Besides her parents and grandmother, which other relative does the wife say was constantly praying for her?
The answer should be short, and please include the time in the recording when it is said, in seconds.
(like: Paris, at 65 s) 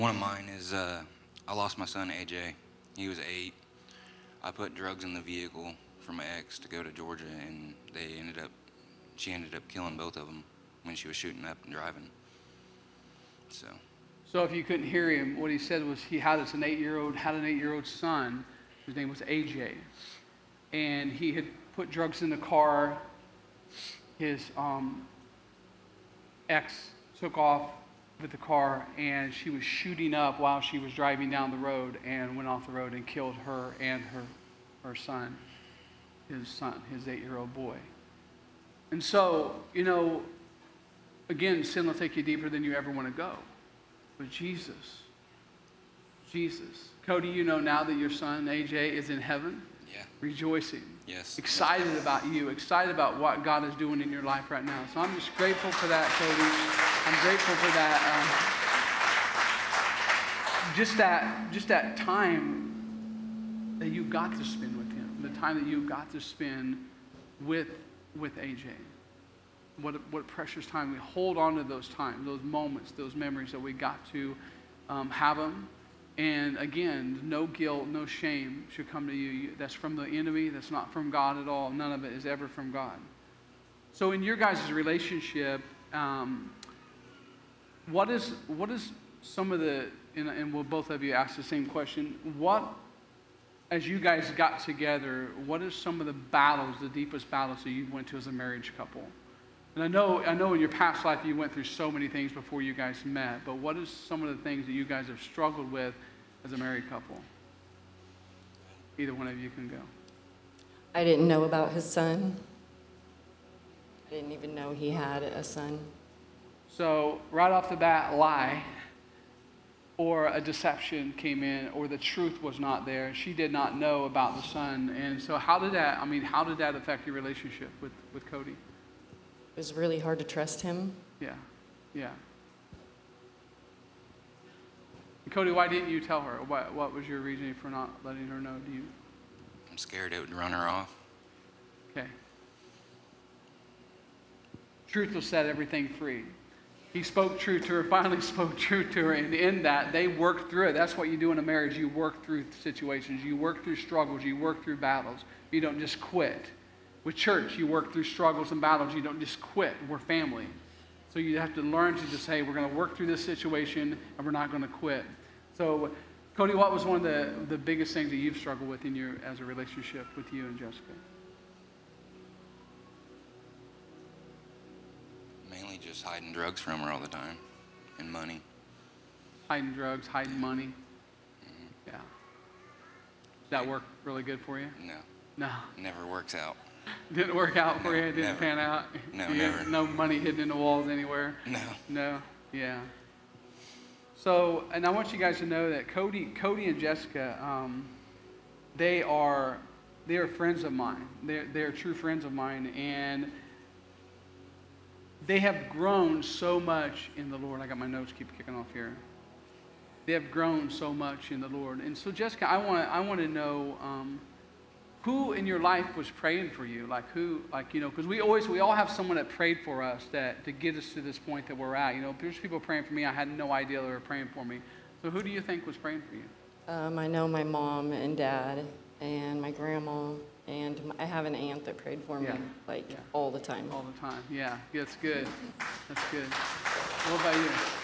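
an aunt, at 231 s.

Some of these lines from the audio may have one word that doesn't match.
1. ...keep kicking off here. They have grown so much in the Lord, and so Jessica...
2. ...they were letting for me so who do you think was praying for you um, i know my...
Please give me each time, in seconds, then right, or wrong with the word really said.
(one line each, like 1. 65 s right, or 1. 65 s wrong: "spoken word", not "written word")
1. 208 s right
2. 223 s wrong: "praying", not "letting".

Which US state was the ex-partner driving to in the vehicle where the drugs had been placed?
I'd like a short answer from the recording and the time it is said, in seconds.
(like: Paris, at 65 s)
Georgia, at 6 s.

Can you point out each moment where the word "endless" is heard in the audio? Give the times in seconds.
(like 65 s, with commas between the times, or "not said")
not said.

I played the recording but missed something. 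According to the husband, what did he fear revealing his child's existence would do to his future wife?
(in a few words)
run her off.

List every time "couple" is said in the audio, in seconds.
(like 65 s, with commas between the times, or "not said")
98 s, 106 s.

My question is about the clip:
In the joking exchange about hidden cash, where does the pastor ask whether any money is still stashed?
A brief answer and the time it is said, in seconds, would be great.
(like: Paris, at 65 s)
in the walls, at 190 s.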